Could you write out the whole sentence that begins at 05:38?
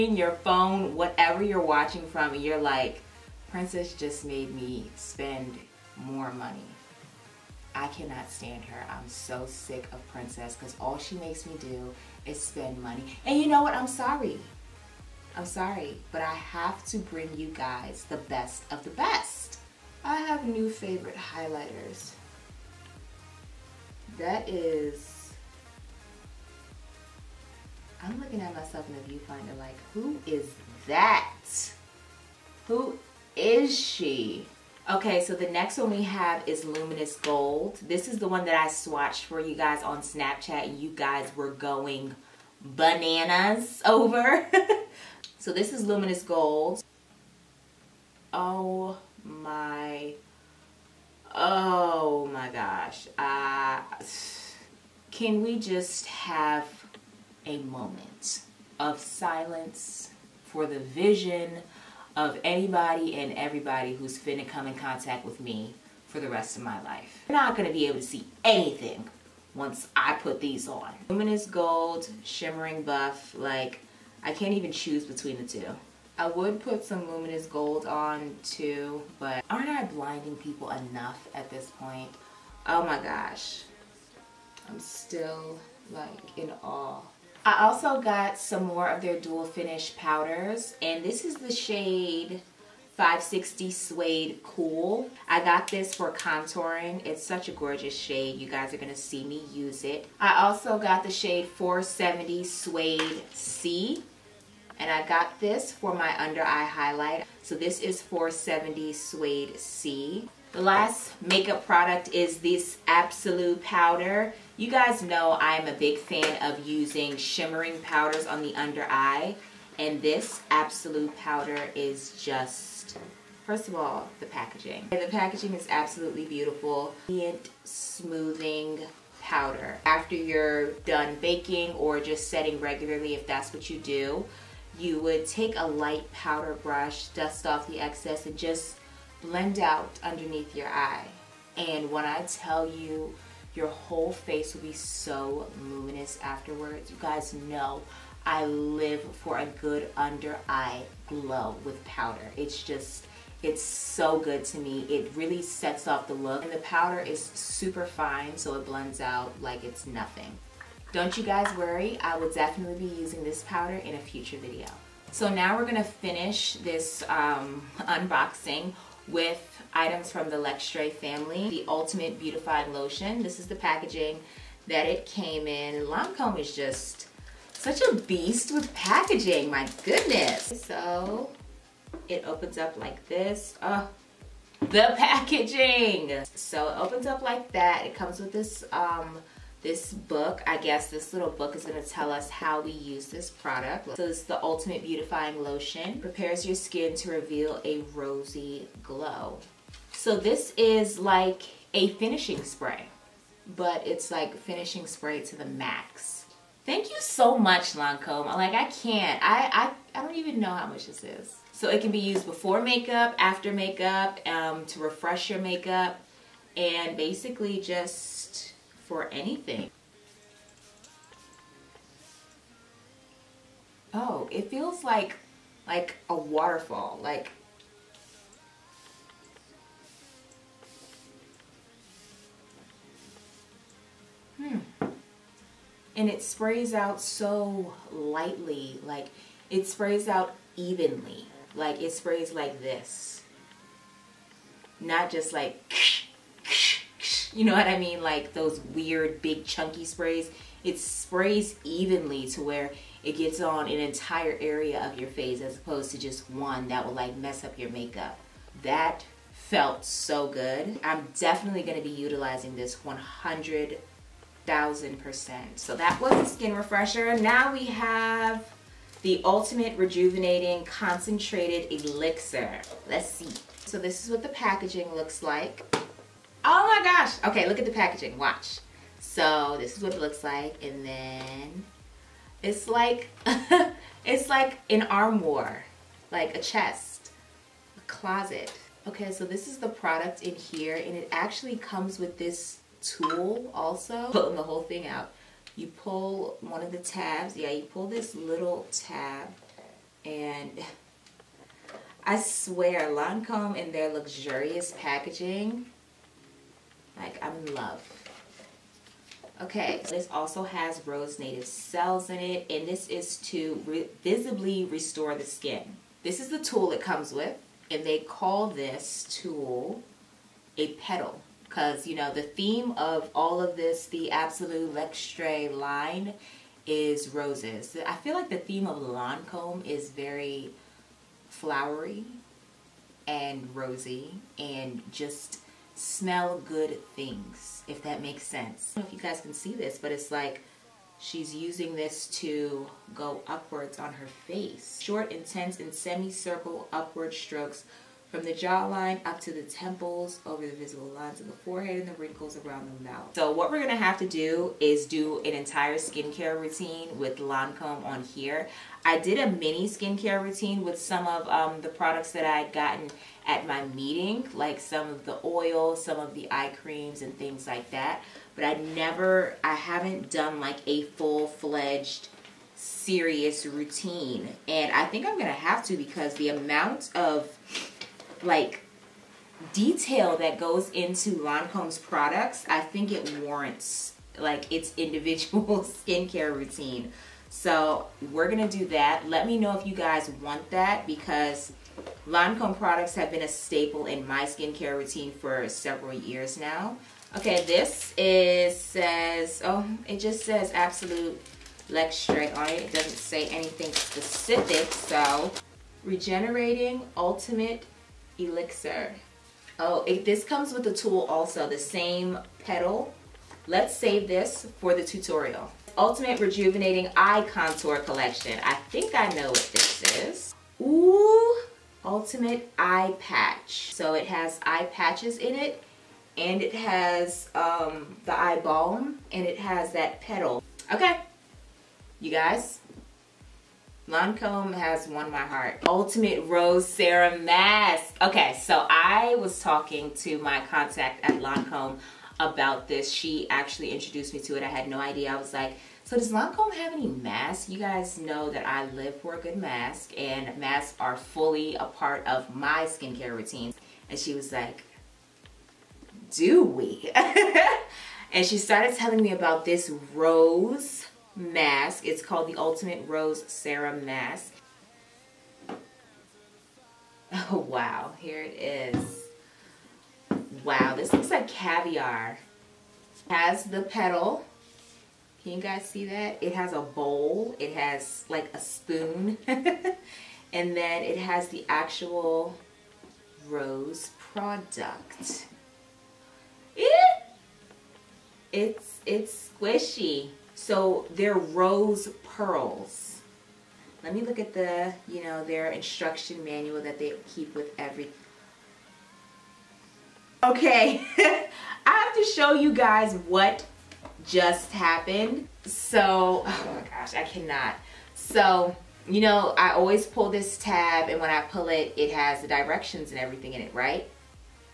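I don't know if you guys can see this, but it's like she's using this to go upwards on her face.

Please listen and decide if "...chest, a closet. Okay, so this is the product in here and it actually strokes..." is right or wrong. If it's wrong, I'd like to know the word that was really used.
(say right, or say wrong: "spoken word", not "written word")
wrong: "comes", not "strokes".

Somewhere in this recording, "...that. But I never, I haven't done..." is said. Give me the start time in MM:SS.
06:07.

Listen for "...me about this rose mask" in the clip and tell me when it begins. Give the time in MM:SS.
07:39.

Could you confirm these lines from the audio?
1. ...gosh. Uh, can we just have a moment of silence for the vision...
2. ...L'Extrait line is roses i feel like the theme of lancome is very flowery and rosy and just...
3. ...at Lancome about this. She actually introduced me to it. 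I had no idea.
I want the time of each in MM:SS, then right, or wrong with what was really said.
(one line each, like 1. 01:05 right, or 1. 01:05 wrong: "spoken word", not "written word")
1. 00:52 right
2. 05:24 right
3. 07:21 right.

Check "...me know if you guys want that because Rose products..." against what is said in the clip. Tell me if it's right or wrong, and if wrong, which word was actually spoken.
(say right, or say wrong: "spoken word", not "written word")
wrong: "Lancome", not "Rose".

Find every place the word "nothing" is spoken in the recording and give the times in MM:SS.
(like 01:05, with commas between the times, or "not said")
02:39.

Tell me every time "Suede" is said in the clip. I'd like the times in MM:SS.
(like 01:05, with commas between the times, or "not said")
01:33, 01:42, 01:48.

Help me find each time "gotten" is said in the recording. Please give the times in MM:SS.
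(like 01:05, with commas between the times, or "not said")
06:02.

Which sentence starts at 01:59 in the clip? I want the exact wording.
And this Absolute Powder is just, first of all, the packaging.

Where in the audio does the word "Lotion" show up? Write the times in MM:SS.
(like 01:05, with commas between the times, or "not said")
02:52, 03:15.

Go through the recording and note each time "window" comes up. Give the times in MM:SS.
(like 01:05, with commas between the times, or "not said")
not said.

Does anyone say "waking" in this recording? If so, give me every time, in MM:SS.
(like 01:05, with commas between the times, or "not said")
not said.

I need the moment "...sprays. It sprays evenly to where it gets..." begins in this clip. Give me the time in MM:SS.
04:09.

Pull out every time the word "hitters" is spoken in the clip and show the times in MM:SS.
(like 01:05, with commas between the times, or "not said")
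not said.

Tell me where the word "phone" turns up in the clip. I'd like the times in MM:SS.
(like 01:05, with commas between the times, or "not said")
00:00.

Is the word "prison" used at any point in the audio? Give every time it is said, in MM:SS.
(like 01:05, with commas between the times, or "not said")
not said.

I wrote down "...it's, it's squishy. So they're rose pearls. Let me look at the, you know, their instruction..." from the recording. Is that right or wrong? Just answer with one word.
right.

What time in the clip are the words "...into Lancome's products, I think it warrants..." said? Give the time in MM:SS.
06:20.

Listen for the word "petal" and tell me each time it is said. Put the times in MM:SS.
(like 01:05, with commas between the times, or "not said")
05:20, 06:52, 07:09, 07:53.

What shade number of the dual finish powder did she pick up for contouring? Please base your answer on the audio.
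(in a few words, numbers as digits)
560.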